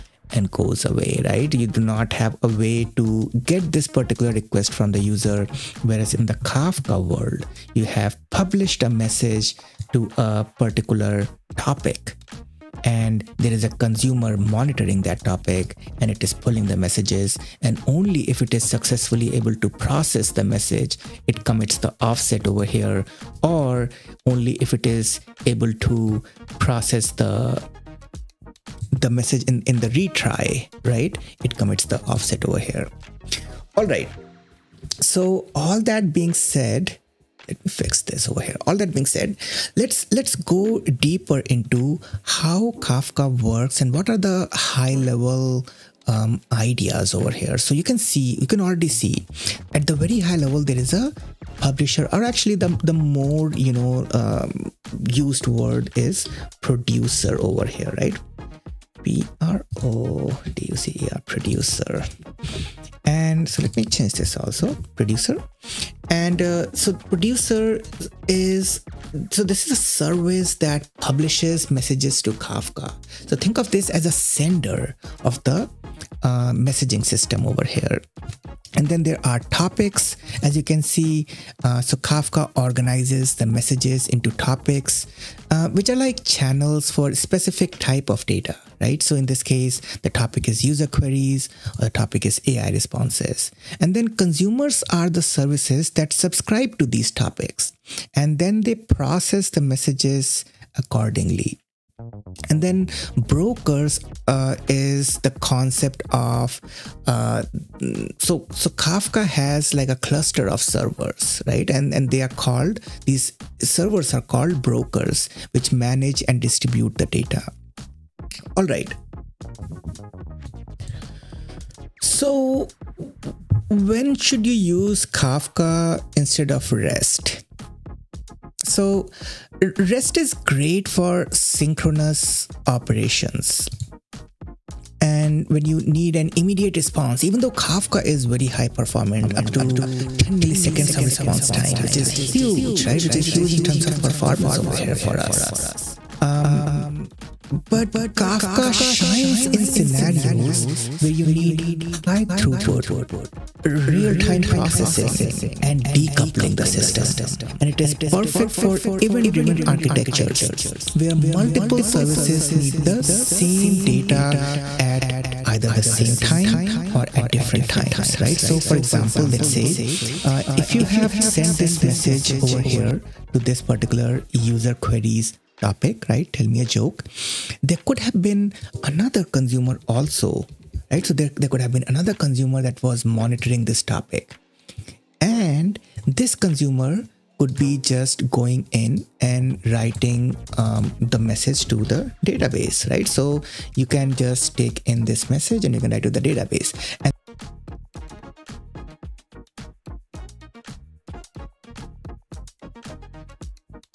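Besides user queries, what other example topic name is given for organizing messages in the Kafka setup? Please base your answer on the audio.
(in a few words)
AI responses.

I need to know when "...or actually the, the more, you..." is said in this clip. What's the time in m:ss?
0:52.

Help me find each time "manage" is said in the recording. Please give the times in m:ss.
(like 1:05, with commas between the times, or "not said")
1:55.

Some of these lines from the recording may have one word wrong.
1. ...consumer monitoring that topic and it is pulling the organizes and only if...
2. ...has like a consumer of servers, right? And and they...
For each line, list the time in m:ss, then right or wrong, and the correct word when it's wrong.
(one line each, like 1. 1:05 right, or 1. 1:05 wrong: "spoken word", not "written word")
1. 0:13 wrong: "messages", not "organizes"
2. 1:49 wrong: "cluster", not "consumer".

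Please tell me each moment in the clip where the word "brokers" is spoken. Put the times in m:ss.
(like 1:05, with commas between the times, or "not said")
1:43, 1:54.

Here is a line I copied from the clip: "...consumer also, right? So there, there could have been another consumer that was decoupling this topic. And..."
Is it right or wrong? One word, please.
wrong.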